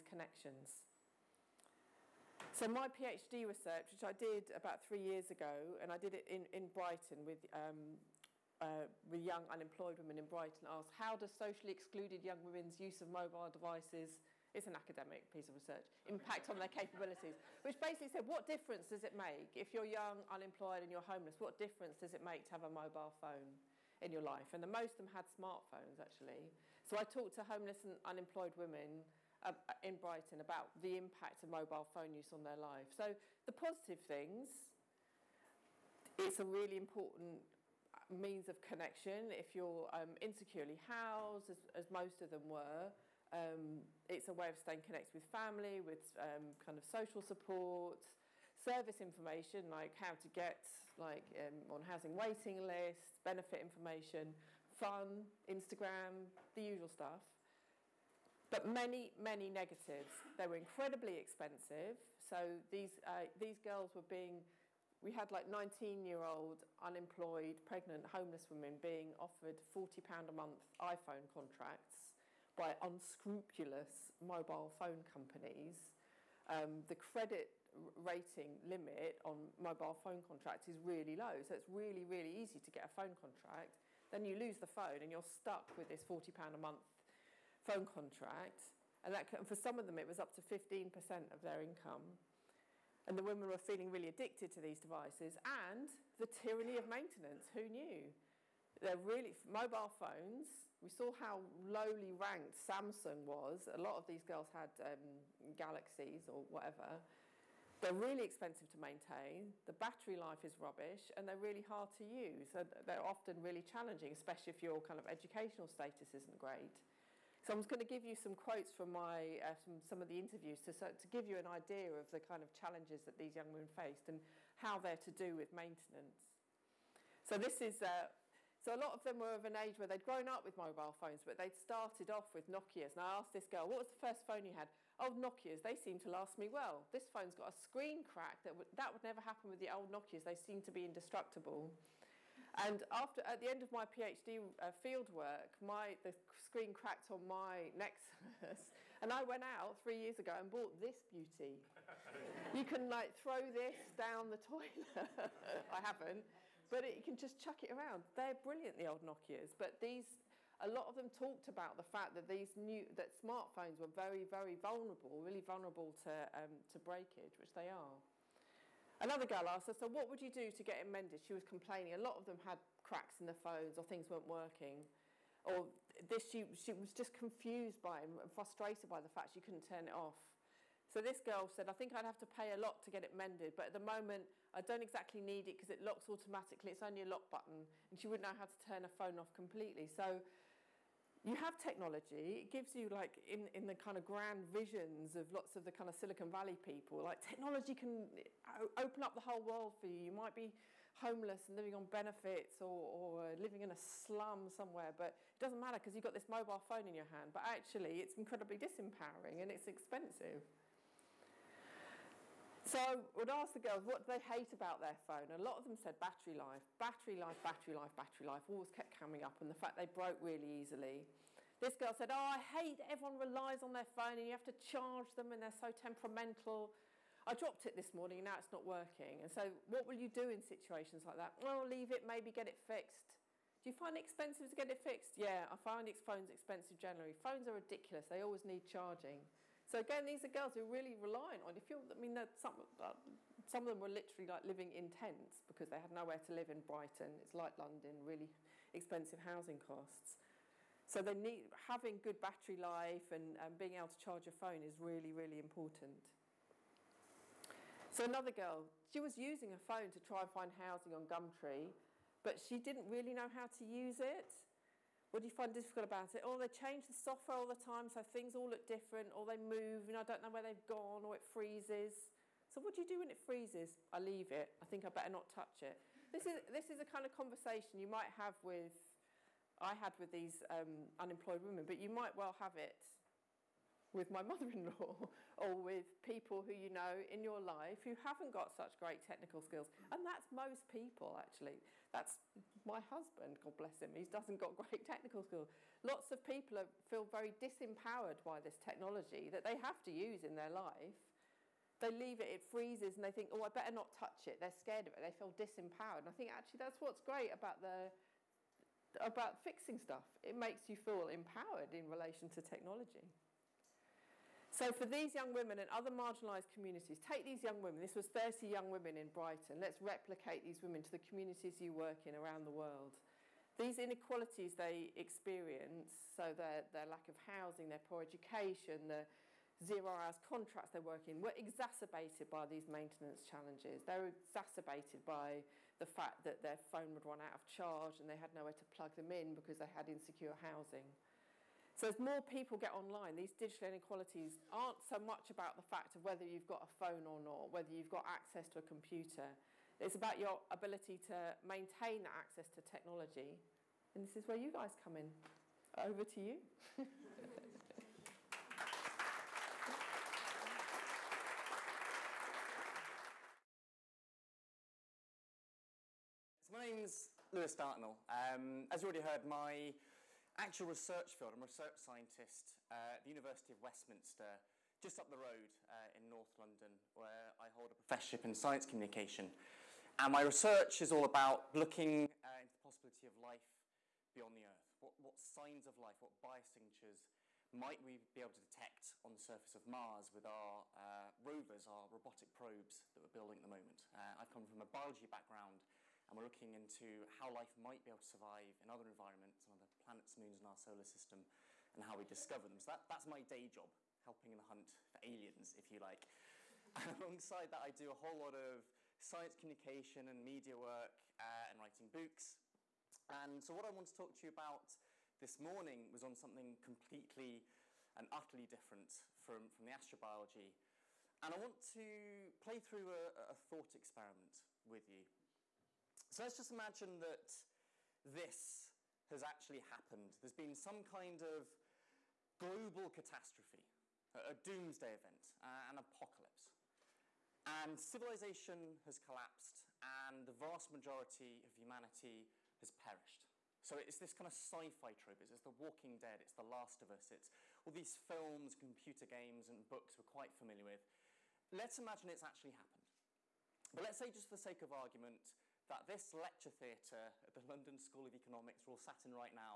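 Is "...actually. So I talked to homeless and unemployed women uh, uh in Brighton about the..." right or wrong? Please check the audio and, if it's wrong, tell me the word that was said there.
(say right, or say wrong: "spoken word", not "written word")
right.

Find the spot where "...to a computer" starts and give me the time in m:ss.
5:48.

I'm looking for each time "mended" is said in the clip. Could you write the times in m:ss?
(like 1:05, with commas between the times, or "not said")
2:50, 3:03.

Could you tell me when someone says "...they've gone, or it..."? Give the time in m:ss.
4:30.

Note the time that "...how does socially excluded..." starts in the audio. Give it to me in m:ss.
0:10.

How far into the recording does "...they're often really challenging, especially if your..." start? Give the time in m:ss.
1:52.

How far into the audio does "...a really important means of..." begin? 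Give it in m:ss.
0:36.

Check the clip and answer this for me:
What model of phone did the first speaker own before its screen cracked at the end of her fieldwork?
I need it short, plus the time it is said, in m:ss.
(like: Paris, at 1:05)
Nexus, at 2:27.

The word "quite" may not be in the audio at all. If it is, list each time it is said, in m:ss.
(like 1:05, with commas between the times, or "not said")
7:30.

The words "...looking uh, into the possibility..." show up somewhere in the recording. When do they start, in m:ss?
6:21.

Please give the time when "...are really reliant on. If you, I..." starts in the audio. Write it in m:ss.
4:00.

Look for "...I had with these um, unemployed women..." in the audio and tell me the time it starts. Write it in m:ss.
4:39.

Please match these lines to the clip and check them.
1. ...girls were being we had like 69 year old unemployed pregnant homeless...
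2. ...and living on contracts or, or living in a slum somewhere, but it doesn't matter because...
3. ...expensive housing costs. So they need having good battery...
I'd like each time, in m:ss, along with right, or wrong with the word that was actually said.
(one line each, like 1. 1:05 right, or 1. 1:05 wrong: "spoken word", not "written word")
1. 1:03 wrong: "19", not "69"
2. 3:21 wrong: "benefits", not "contracts"
3. 4:08 right.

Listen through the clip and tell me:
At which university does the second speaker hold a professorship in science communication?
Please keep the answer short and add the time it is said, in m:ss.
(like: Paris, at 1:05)
University of Westminster, at 6:13.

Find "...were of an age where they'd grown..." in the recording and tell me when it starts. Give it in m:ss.
2:09.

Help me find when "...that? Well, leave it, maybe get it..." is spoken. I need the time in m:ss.
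3:51.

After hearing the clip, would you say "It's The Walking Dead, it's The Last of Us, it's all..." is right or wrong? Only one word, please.
right.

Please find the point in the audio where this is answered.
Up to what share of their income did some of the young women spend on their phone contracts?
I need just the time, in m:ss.
1:30.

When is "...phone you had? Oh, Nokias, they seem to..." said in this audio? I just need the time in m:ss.
2:14.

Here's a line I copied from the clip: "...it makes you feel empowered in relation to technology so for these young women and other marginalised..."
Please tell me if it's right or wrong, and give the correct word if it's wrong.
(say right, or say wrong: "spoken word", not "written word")
right.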